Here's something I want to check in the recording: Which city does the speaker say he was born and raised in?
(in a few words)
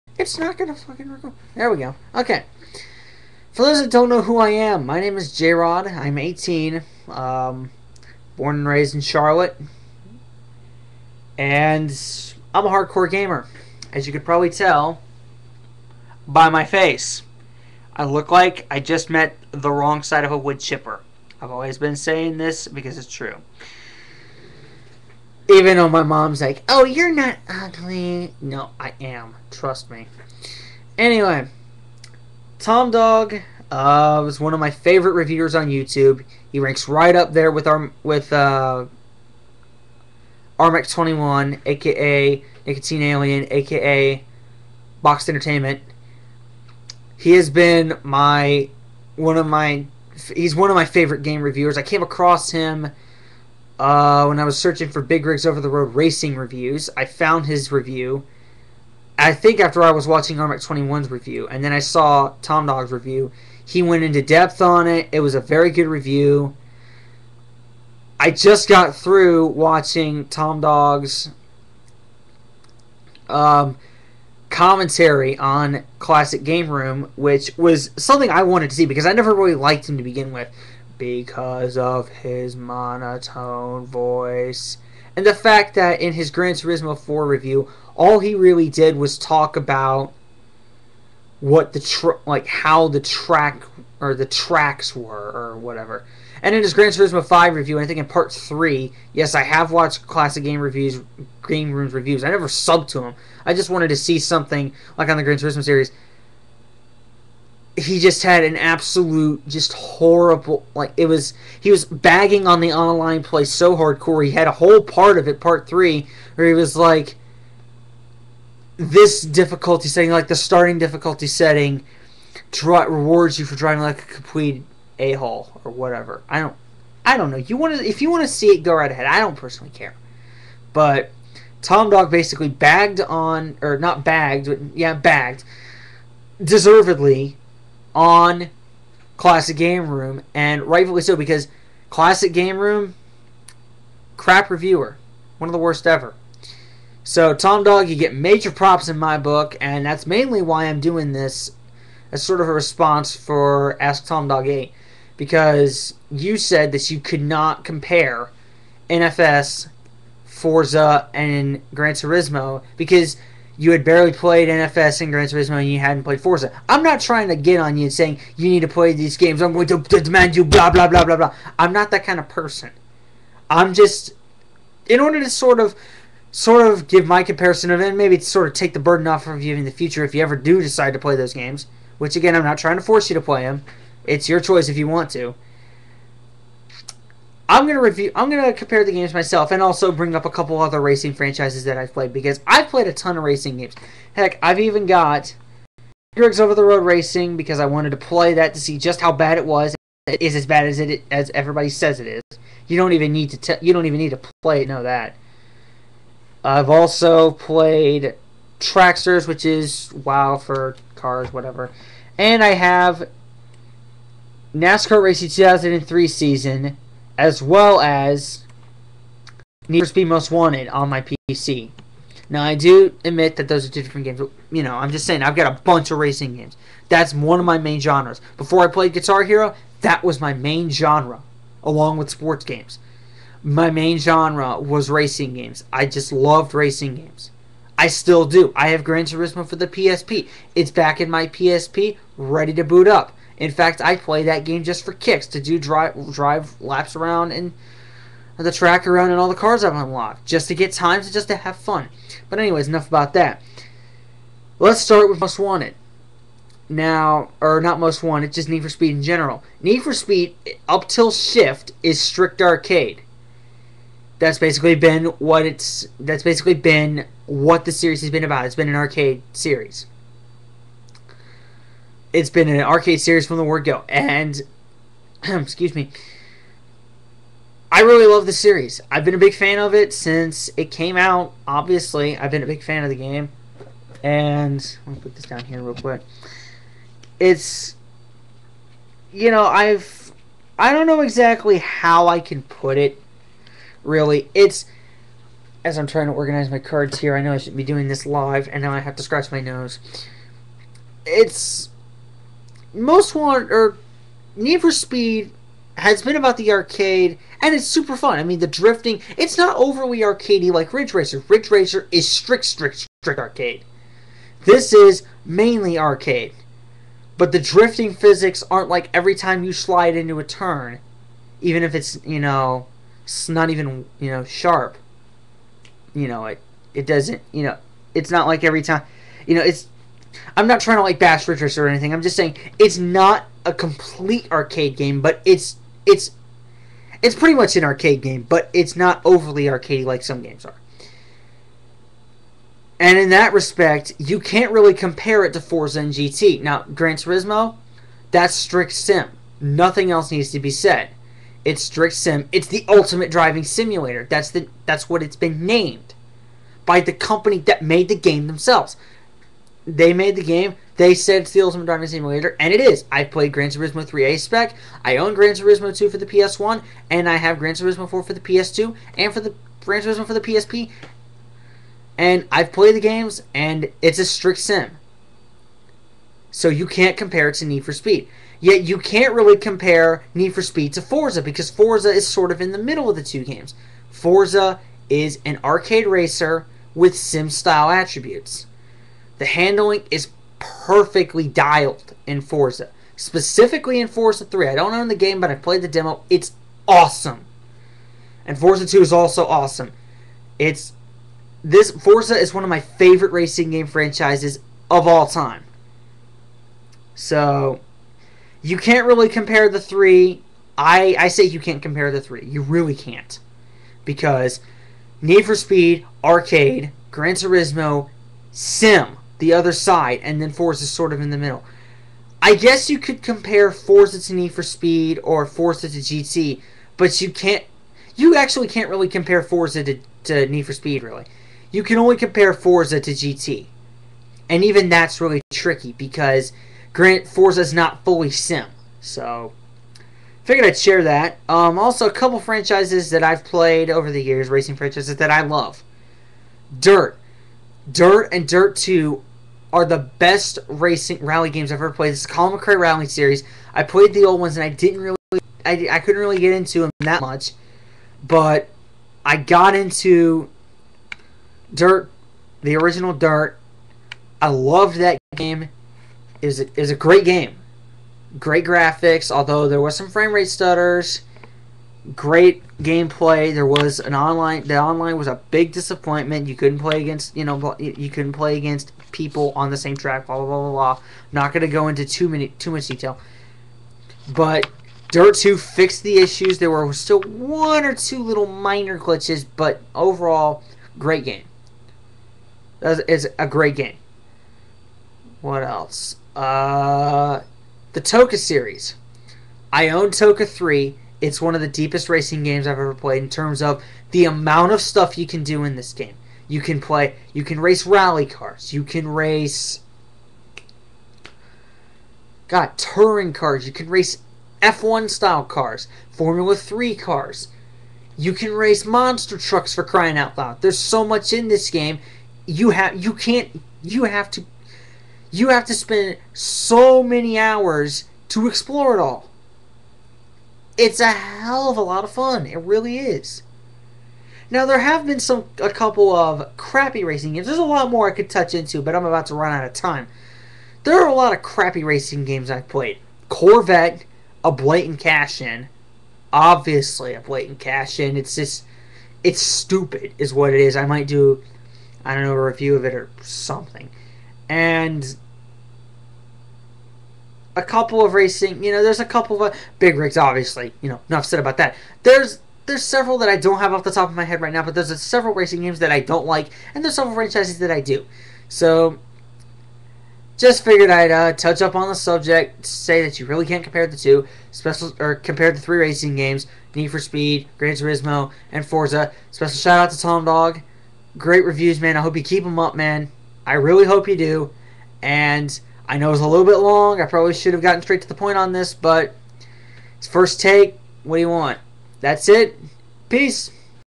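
Charlotte.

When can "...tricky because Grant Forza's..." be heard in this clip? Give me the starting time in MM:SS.
07:15.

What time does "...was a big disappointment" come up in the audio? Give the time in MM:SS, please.
07:54.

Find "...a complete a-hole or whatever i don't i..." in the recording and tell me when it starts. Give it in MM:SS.
02:04.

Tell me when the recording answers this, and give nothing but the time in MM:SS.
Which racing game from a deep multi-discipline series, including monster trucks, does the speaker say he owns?
08:19.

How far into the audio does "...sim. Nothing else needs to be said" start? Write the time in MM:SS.
05:48.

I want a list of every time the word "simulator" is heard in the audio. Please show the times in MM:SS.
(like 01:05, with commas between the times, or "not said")
05:53, 06:01.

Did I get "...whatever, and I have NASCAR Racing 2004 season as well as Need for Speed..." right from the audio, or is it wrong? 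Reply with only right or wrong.
wrong.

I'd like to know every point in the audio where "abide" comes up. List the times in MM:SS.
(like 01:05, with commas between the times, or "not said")
not said.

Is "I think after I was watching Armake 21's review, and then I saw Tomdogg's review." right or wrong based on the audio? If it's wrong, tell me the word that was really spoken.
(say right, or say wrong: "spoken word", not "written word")
right.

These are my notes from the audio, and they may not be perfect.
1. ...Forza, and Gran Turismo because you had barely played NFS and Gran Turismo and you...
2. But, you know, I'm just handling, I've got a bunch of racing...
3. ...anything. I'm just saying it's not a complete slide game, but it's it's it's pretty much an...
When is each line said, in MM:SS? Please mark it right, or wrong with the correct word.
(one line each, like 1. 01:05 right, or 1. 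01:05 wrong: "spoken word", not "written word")
1. 02:40 right
2. 03:44 wrong: "saying", not "handling"
3. 05:31 wrong: "arcade", not "slide".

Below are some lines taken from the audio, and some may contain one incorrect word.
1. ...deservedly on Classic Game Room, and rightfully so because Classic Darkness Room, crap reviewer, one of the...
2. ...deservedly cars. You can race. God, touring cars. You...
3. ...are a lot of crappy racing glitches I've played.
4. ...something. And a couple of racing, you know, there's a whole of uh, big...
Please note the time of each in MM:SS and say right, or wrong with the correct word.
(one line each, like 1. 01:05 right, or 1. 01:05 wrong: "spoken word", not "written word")
1. 02:16 wrong: "Game", not "Darkness"
2. 08:27 wrong: "rally", not "deservedly"
3. 09:00 wrong: "games", not "glitches"
4. 09:13 wrong: "couple", not "whole".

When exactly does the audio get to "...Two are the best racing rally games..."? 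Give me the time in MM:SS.
07:28.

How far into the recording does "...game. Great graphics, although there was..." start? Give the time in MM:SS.
07:47.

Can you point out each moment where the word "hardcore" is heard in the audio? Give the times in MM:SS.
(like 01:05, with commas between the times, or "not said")
00:12, 01:53.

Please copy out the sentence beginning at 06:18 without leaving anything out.
Yet you can't really compare Need for Speed to Forza because Forza is sort of in the middle of the two games.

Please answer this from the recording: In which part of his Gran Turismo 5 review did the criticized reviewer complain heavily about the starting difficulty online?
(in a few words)
Part 3.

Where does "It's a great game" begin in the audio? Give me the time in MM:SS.
08:12.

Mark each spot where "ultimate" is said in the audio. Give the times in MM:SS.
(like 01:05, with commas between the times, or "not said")
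05:52, 06:01.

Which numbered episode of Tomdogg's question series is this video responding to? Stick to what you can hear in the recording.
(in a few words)
8.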